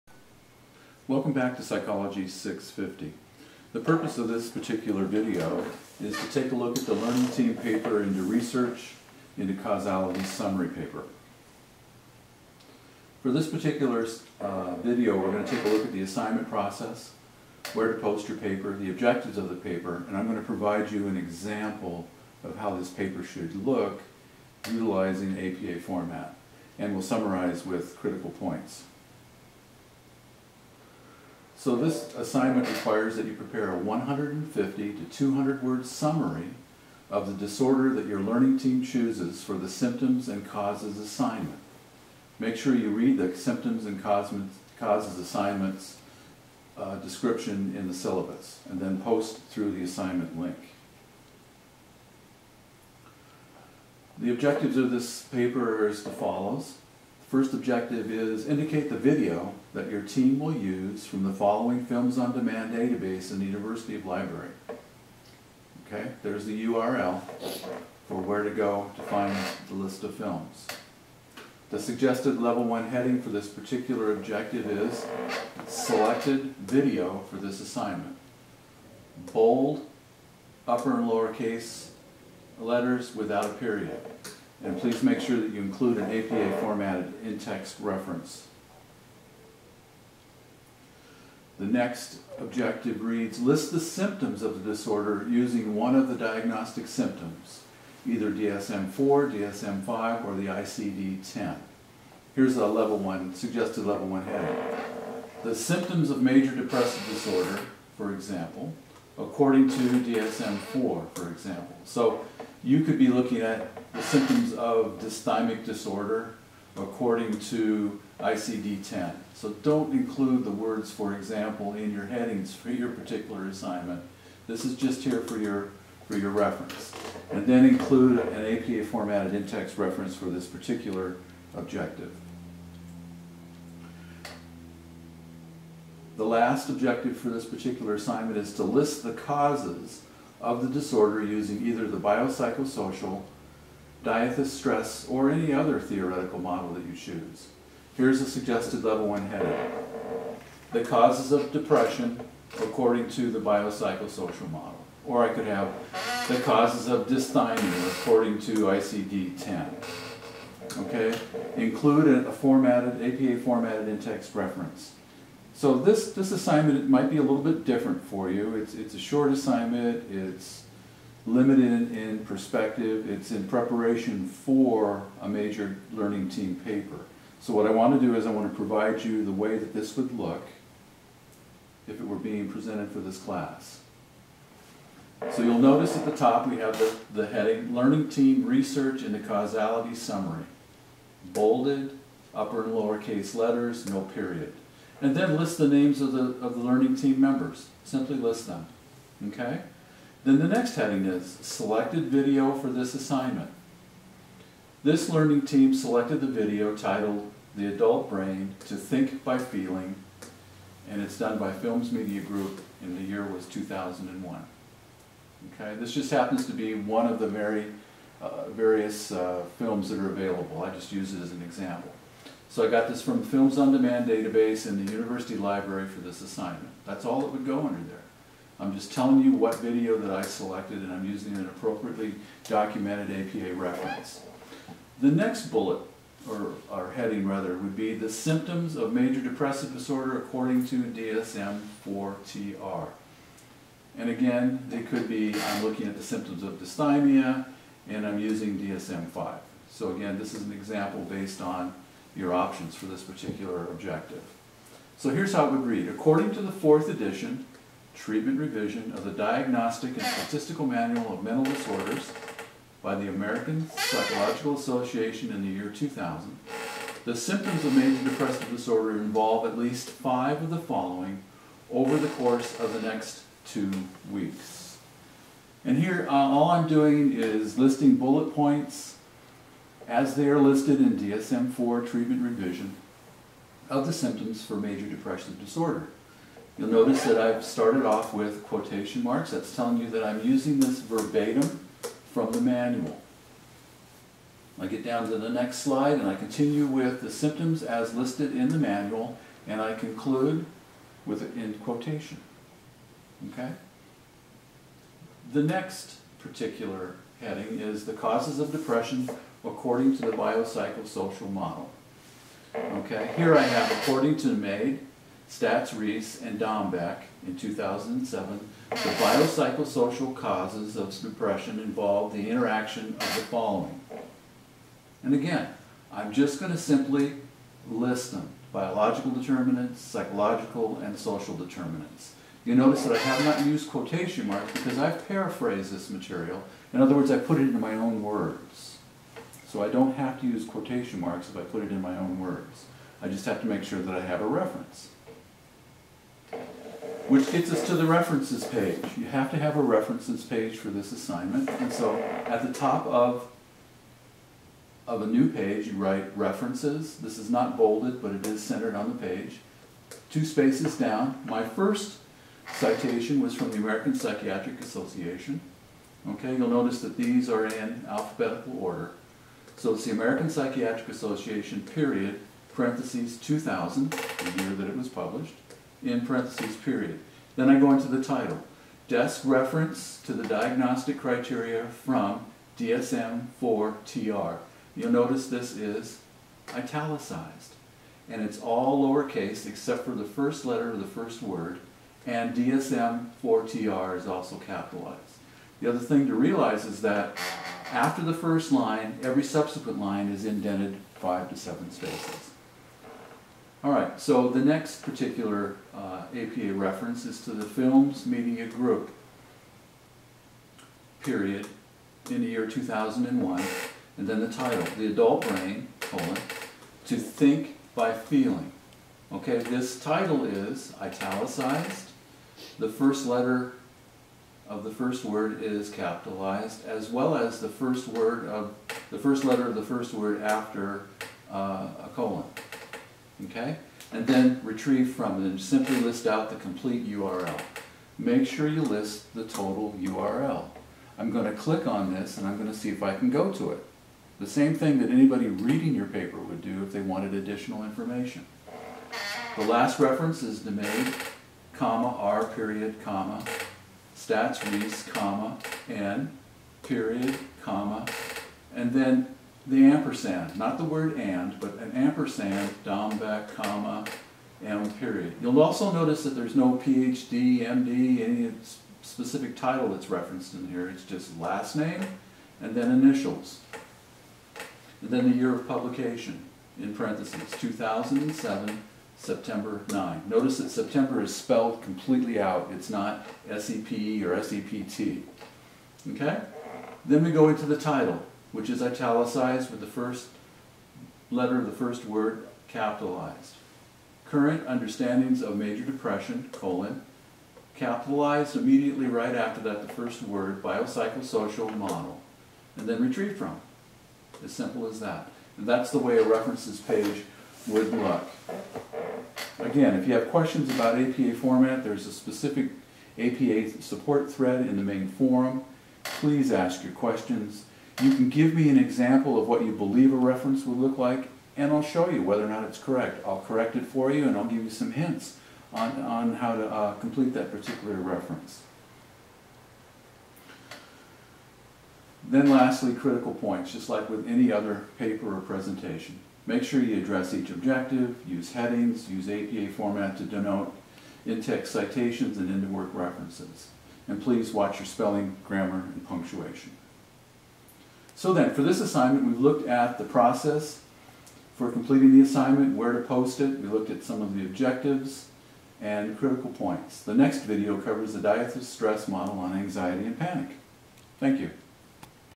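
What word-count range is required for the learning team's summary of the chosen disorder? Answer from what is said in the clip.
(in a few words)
150 to 200.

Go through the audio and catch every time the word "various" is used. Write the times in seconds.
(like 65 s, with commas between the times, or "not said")
218 s.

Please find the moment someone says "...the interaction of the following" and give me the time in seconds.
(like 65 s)
322 s.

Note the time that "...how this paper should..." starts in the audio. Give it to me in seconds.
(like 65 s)
22 s.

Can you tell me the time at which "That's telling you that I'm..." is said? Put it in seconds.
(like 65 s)
289 s.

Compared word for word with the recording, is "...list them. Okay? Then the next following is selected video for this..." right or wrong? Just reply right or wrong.
wrong.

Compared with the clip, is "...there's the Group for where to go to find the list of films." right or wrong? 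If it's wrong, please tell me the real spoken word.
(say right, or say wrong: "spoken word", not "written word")
wrong: "URL", not "Group".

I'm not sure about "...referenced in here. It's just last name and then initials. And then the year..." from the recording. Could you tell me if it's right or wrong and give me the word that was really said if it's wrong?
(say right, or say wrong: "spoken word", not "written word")
right.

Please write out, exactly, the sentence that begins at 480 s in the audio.
Notice that September is spelled completely out.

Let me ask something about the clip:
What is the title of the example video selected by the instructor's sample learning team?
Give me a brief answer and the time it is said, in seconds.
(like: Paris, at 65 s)
The Adult Brain: To Think by Feeling, at 207 s.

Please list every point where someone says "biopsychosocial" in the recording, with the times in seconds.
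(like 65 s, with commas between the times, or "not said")
141 s, 153 s, 310 s, 318 s, 500 s.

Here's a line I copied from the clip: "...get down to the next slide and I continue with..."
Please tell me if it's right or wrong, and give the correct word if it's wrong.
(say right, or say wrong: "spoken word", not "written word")
right.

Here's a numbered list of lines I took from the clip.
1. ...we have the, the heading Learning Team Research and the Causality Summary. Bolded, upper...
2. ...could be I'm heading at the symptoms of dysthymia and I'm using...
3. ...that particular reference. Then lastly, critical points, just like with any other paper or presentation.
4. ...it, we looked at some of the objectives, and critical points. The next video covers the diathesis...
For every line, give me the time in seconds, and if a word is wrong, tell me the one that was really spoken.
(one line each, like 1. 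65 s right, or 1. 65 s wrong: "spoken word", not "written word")
1. 186 s right
2. 244 s wrong: "looking", not "heading"
3. 527 s right
4. 553 s right.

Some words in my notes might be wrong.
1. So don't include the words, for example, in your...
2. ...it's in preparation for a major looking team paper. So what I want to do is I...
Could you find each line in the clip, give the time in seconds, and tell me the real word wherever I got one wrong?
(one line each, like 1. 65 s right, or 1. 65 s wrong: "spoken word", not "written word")
1. 119 s right
2. 173 s wrong: "learning", not "looking".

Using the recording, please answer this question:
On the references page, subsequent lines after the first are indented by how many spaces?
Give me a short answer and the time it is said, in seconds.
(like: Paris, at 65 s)
5 to 7, at 400 s.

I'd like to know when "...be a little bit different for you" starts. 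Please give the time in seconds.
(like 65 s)
167 s.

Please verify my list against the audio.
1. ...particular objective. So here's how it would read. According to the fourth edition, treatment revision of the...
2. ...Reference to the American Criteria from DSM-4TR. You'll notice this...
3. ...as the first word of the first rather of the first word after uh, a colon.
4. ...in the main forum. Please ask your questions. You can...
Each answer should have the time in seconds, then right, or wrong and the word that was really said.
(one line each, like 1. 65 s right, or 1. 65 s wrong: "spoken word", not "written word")
1. 253 s right
2. 379 s wrong: "Diagnostic", not "American"
3. 427 s wrong: "letter", not "rather"
4. 514 s right.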